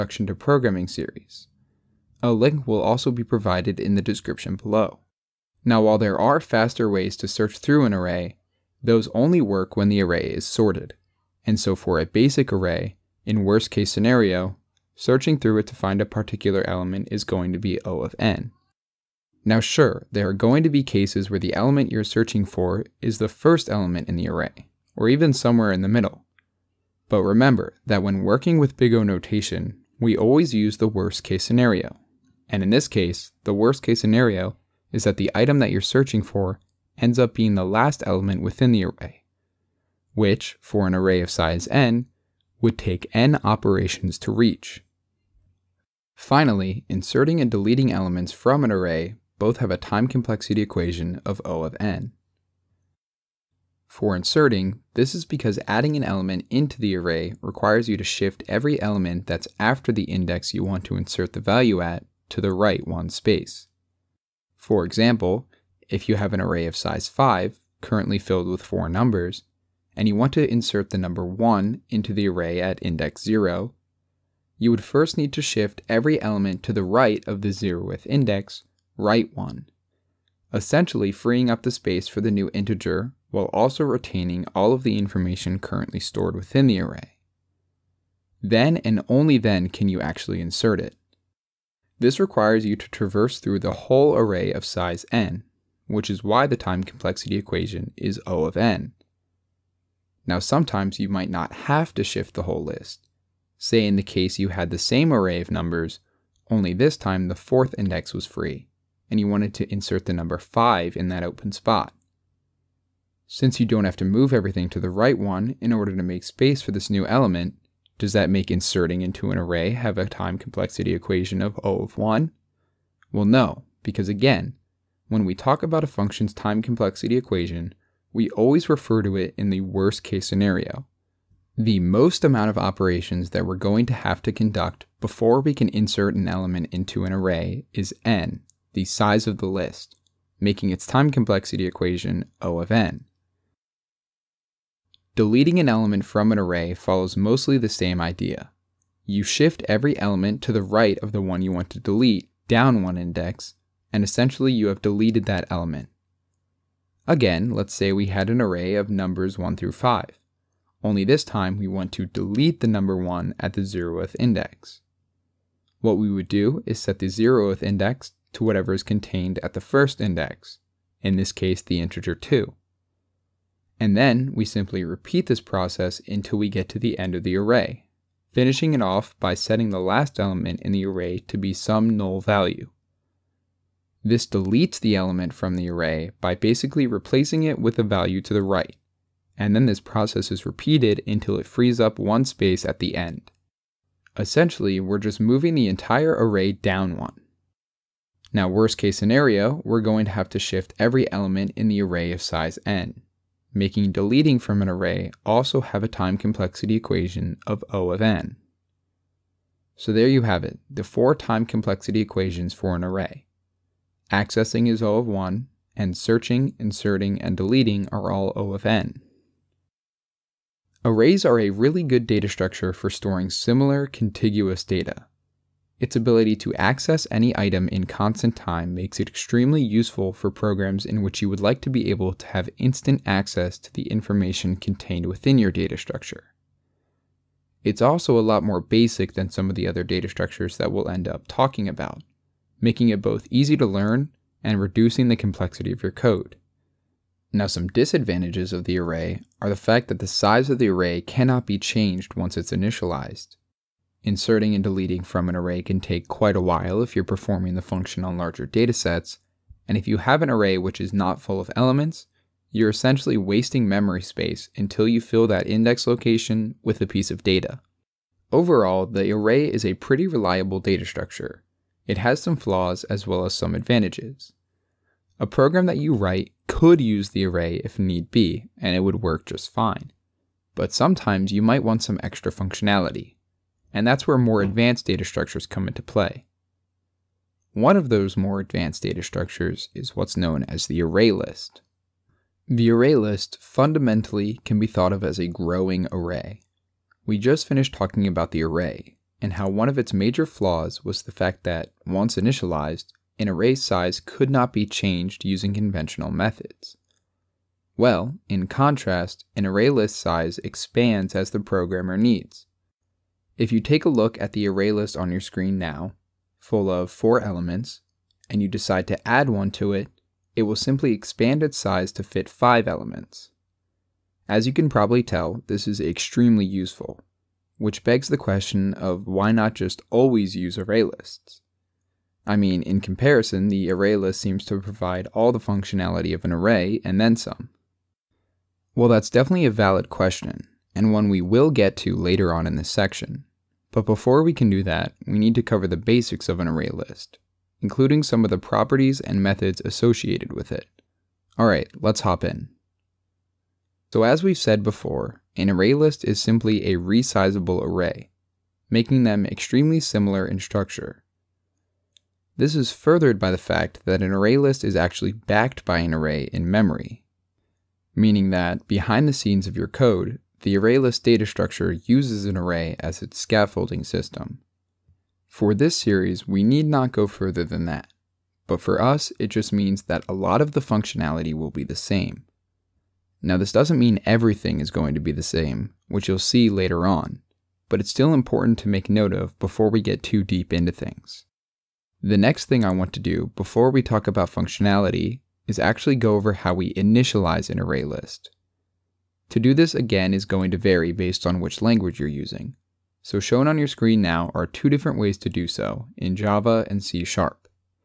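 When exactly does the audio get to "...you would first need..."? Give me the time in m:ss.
1:14.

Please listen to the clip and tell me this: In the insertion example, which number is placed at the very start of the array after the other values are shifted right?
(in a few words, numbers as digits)
1.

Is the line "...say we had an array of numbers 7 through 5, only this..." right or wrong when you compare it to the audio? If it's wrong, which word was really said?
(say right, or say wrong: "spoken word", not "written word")
wrong: "1", not "7".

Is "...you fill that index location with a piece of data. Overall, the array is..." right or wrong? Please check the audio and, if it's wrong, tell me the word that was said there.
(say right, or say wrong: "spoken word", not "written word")
right.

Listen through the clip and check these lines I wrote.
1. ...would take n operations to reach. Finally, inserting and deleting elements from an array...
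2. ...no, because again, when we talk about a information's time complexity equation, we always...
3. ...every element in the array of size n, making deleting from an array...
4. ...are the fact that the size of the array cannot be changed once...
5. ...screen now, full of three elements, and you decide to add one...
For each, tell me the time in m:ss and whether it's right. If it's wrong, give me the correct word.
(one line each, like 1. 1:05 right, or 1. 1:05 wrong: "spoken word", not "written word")
1. 0:42 right
2. 2:03 wrong: "function", not "information"
3. 3:20 right
4. 4:09 right
5. 5:15 wrong: "four", not "three".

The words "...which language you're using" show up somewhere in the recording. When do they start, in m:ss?
6:41.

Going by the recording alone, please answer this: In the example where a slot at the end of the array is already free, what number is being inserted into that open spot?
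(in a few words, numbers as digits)
5.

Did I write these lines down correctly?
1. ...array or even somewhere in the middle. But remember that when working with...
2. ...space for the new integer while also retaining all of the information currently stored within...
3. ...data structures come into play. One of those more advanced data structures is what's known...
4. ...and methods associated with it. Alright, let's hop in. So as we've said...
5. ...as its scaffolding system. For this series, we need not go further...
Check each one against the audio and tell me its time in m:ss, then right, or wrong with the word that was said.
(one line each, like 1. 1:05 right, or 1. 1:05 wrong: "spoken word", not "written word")
1. 0:24 right
2. 1:21 right
3. 4:44 right
4. 5:49 right
5. 6:12 right.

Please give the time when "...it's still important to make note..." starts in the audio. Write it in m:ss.
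6:27.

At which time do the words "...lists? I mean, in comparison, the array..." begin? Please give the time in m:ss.
5:30.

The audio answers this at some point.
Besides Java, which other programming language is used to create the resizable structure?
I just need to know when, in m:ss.
6:46.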